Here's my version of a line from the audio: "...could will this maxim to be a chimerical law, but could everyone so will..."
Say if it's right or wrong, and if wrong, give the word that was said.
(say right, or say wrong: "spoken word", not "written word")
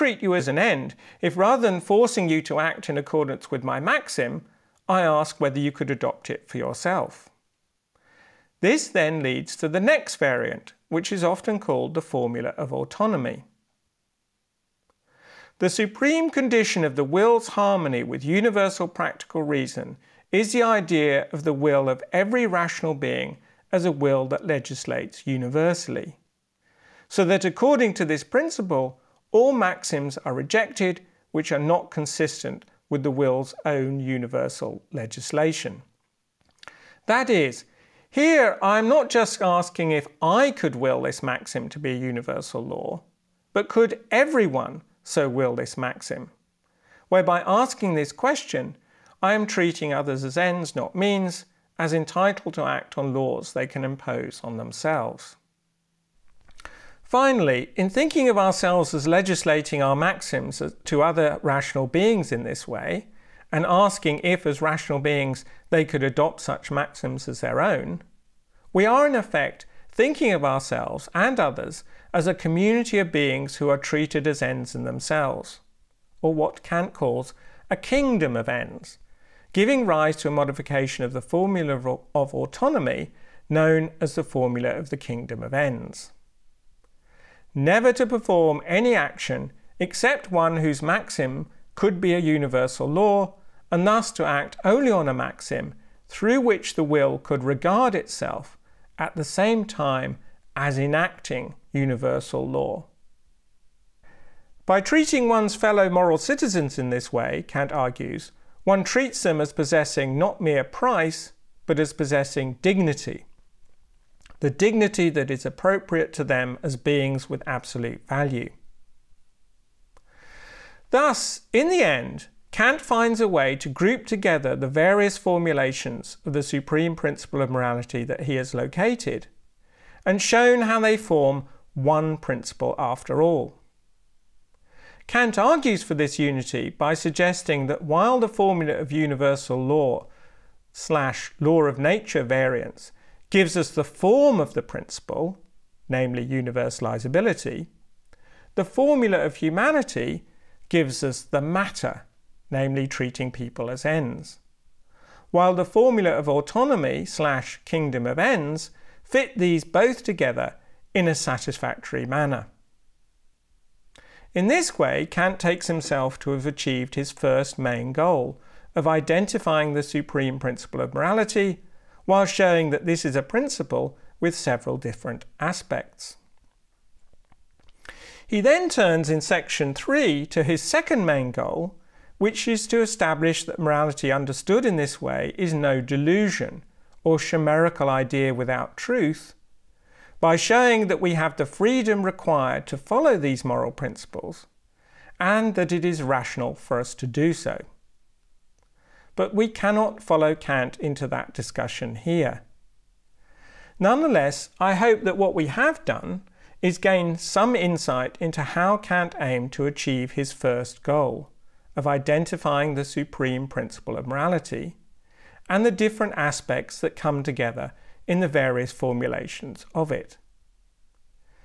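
wrong: "universal", not "chimerical".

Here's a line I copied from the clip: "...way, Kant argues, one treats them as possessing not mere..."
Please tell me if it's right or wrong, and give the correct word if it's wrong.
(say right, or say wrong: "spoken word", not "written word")
right.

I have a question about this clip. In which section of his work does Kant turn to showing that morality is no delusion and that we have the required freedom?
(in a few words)
Section 3.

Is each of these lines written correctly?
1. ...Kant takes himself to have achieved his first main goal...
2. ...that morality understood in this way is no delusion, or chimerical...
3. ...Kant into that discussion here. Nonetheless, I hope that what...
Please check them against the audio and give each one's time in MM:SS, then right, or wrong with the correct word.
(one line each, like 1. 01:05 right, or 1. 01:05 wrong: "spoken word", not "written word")
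1. 02:45 right
2. 03:03 right
3. 03:20 right.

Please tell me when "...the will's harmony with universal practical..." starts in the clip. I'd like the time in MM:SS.
00:16.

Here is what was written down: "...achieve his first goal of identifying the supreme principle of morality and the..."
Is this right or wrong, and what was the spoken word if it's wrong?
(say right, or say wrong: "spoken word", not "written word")
right.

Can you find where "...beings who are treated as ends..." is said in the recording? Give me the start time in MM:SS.
01:13.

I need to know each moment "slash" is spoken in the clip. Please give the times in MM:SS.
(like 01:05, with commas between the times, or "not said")
02:20, 02:37.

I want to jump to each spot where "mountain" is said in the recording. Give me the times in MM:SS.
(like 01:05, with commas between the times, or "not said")
not said.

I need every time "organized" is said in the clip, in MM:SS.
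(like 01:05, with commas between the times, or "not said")
not said.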